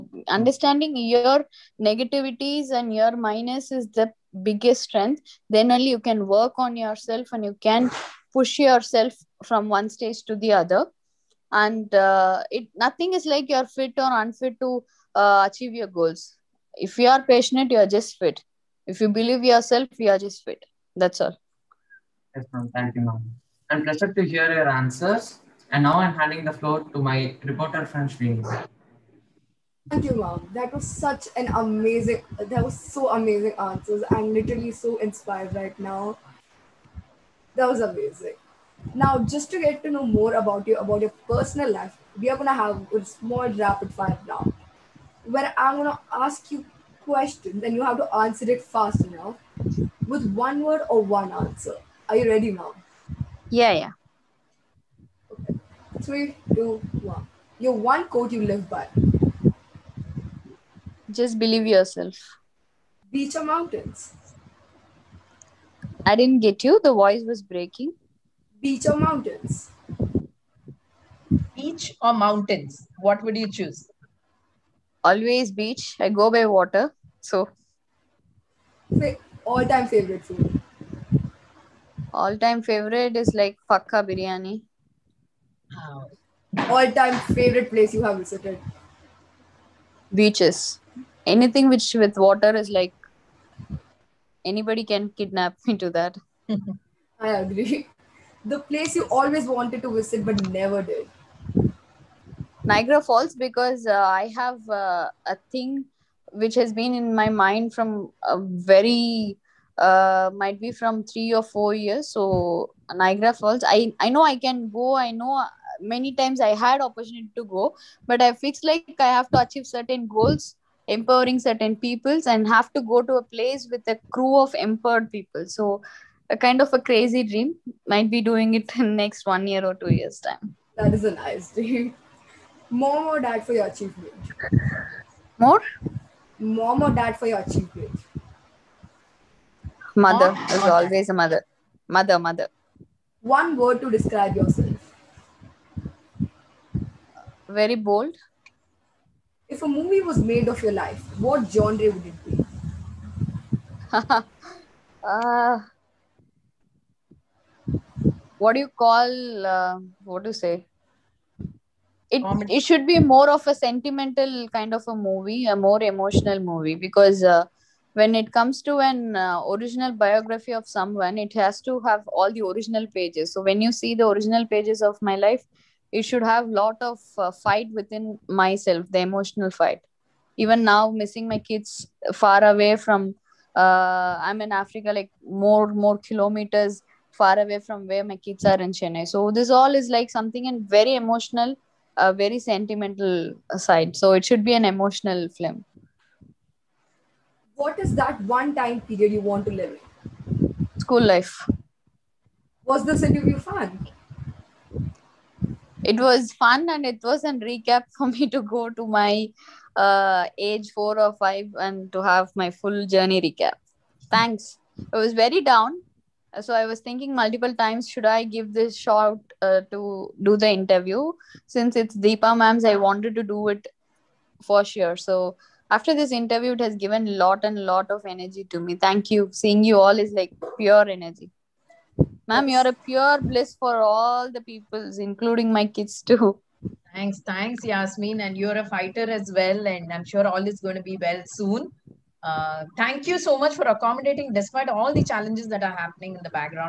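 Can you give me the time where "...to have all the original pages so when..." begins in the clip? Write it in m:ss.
2:51.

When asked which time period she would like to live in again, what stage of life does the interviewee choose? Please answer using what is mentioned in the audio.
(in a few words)
School life.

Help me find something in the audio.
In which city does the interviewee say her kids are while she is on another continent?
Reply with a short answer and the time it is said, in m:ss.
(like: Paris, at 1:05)
Chennai, at 3:08.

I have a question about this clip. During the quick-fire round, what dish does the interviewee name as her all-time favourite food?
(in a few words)
Fakka biryani.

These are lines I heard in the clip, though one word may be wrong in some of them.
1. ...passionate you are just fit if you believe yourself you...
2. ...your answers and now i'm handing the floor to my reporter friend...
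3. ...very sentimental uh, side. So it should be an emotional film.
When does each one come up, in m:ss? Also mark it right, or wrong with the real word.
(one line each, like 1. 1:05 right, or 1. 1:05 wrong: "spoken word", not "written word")
1. 0:17 right
2. 0:24 right
3. 3:12 right.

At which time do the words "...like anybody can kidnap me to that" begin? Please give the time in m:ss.
1:32.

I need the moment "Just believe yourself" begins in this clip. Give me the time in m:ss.
1:01.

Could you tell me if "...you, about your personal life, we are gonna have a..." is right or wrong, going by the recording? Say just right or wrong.
right.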